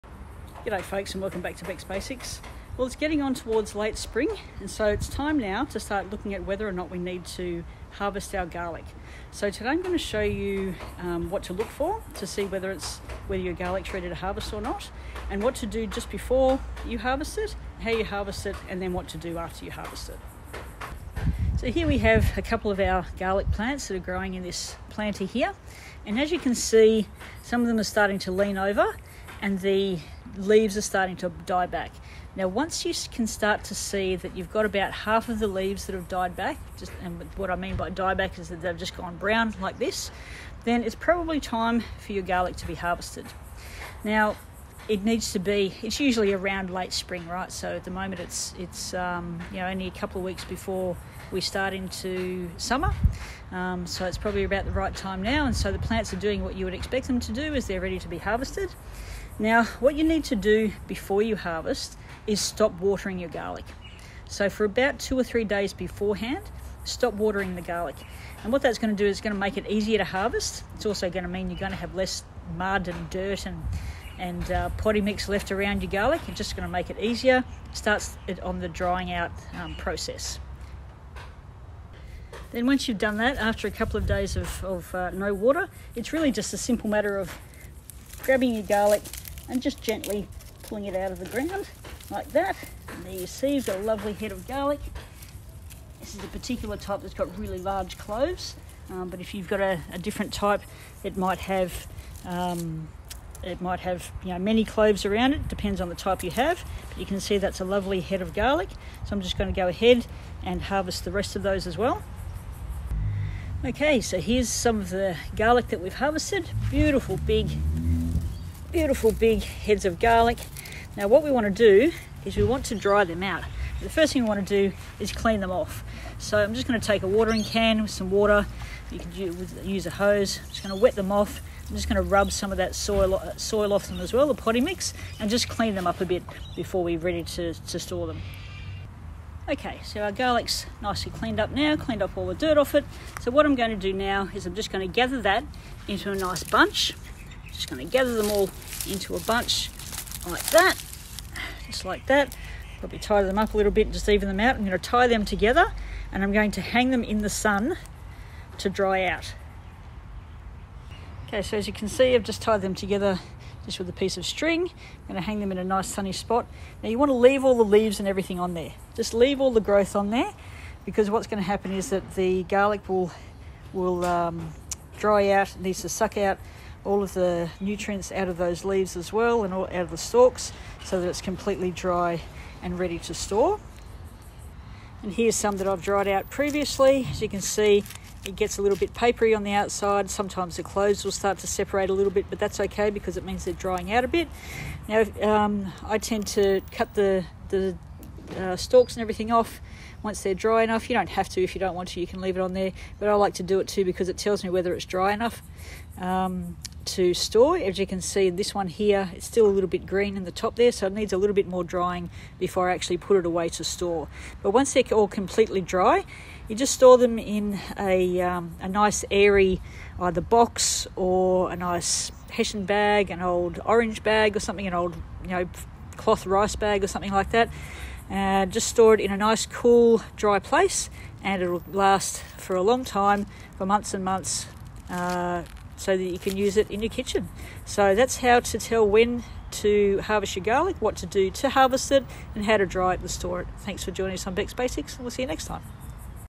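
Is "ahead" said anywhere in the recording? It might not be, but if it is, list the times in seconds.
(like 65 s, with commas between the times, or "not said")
109 s.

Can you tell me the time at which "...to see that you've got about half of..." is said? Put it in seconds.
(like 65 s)
33 s.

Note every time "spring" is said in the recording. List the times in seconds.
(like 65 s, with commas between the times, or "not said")
3 s, 46 s.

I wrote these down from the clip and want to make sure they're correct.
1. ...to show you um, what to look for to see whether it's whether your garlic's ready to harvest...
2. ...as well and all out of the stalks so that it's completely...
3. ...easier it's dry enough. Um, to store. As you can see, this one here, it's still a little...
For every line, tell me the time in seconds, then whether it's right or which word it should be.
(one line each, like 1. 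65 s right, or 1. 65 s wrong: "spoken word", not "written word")
1. 9 s right
2. 178 s right
3. 204 s wrong: "whether", not "easier".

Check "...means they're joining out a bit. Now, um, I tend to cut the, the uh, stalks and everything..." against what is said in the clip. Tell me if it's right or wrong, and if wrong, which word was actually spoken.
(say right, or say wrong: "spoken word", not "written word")
wrong: "drying", not "joining".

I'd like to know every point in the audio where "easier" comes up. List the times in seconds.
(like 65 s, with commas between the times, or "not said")
69 s, 76 s.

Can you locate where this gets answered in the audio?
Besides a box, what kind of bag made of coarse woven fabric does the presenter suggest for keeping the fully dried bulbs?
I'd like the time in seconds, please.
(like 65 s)
222 s.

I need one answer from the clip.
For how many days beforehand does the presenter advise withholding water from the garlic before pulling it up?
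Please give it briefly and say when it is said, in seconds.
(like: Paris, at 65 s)
2 or 3 days, at 64 s.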